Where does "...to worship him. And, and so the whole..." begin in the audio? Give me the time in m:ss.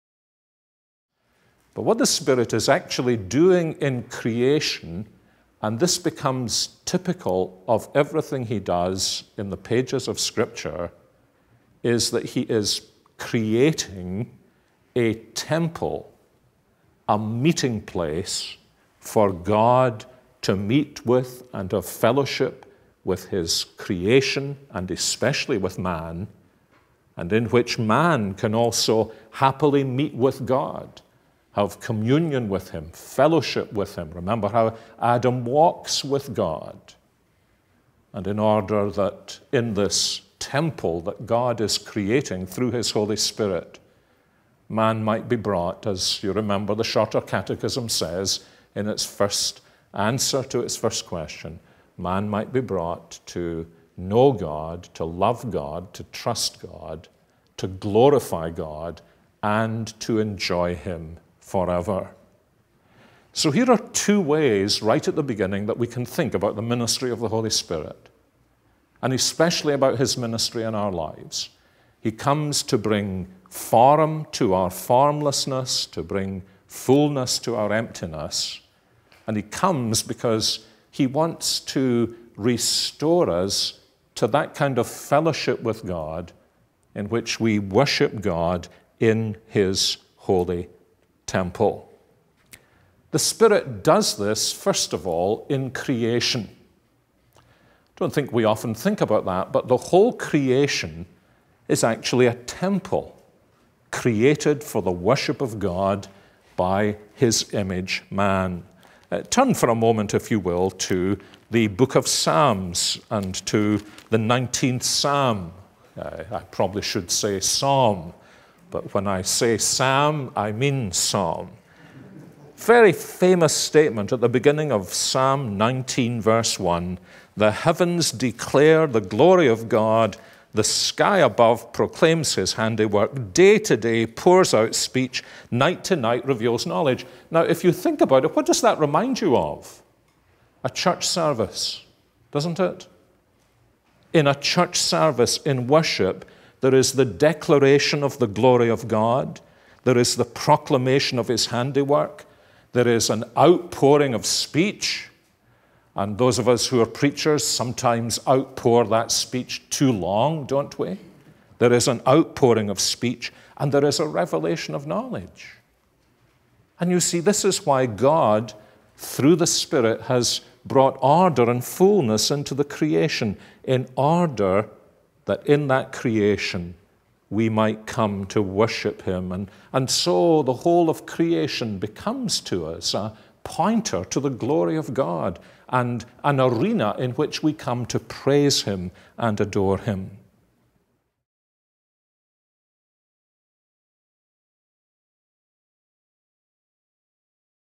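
2:58.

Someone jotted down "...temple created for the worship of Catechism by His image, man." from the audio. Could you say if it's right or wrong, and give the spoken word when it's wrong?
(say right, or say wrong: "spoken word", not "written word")
wrong: "God", not "Catechism".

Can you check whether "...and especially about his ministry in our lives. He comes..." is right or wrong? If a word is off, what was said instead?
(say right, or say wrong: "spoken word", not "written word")
right.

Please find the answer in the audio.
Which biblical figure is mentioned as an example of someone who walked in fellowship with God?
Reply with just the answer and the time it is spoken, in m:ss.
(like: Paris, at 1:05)
Adam, at 0:35.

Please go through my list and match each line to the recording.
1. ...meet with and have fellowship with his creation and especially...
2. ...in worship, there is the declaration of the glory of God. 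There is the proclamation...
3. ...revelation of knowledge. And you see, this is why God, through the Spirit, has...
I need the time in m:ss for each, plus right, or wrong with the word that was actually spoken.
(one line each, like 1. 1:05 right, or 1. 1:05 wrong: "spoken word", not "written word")
1. 0:20 right
2. 2:25 right
3. 2:44 right.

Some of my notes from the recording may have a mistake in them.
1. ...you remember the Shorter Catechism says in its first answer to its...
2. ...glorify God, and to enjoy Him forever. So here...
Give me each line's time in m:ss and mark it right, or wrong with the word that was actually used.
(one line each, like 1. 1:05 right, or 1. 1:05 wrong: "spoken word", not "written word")
1. 0:46 right
2. 0:57 right.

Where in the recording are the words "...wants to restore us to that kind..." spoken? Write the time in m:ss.
1:21.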